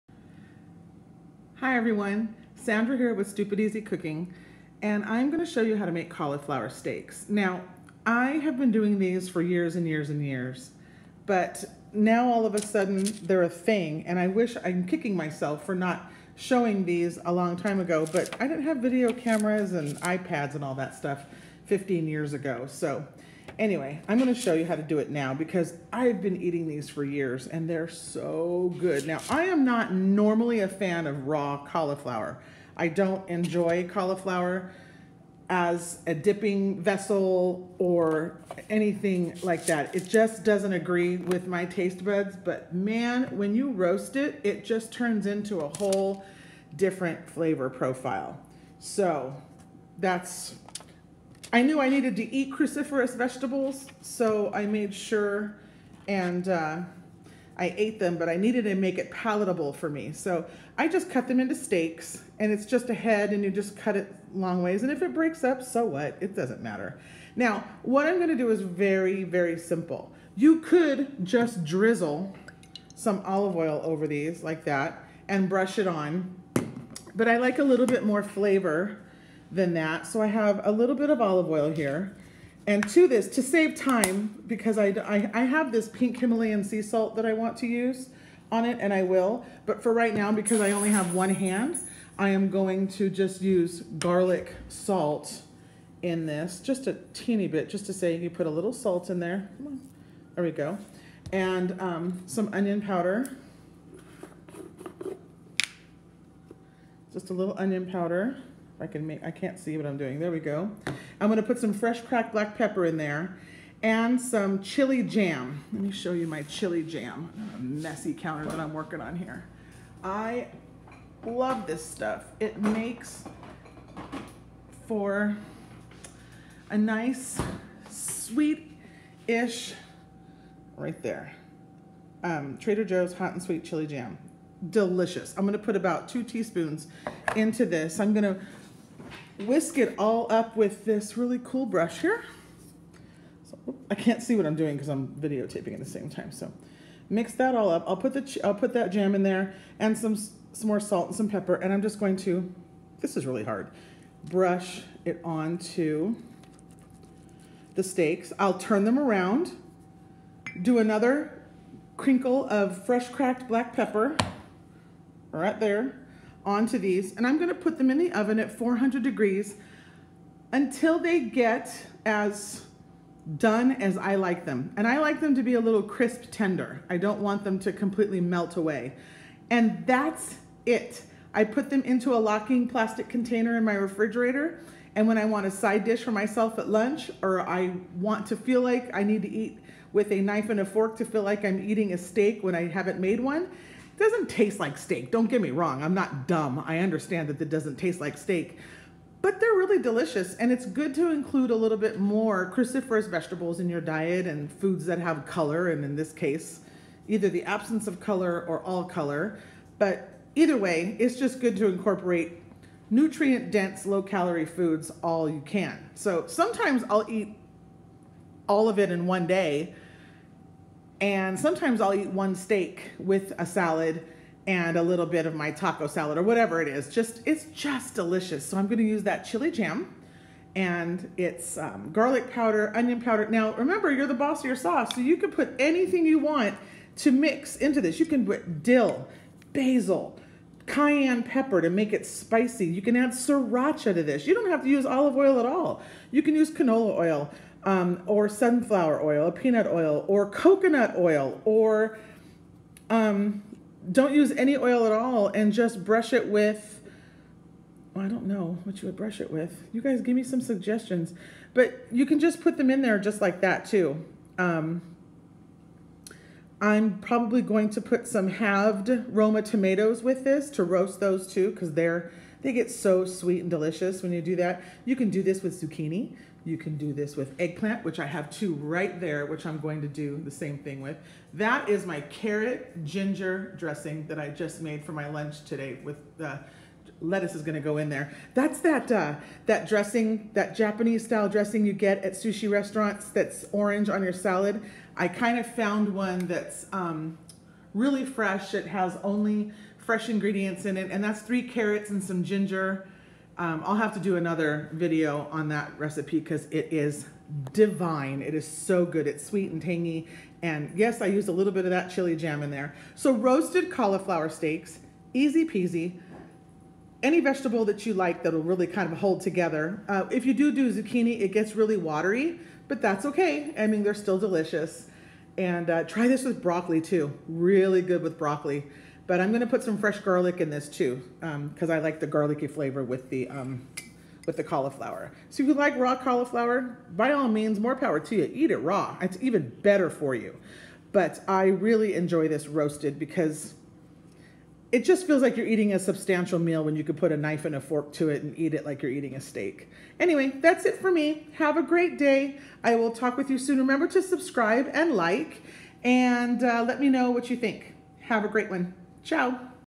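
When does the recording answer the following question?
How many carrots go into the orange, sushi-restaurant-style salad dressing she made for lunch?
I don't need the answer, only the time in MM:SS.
05:01.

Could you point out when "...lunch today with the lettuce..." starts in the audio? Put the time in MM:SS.
04:45.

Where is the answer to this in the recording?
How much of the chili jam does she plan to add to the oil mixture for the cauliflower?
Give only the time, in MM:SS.
02:16.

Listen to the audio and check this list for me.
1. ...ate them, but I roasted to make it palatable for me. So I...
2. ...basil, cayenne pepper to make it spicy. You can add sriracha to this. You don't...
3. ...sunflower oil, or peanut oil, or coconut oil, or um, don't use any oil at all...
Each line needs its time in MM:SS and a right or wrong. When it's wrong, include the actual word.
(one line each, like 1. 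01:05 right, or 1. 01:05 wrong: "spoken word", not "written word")
1. 00:57 wrong: "needed", not "roasted"
2. 03:59 right
3. 04:08 right.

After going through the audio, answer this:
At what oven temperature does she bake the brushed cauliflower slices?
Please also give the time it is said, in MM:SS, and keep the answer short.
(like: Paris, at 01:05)
400 degrees, at 02:48.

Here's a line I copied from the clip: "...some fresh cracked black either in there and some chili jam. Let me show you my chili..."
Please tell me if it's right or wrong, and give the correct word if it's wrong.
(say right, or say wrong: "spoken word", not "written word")
wrong: "pepper", not "either".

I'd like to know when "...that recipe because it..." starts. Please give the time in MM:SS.
05:05.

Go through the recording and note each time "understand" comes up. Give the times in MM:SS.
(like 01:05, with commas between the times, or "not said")
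03:16.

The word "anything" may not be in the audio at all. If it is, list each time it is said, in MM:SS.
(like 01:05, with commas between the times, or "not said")
00:38, 03:55.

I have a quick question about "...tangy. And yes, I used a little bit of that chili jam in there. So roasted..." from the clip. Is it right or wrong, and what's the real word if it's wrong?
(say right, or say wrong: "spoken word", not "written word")
right.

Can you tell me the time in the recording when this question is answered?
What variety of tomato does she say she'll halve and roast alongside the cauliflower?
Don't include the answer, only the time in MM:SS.
04:29.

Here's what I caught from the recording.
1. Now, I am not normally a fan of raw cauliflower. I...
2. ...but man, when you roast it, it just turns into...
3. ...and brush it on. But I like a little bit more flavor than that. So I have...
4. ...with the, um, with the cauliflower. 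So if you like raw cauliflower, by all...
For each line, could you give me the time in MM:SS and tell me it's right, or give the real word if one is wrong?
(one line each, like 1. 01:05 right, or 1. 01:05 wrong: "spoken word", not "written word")
1. 00:29 right
2. 00:42 right
3. 01:15 right
4. 05:32 right.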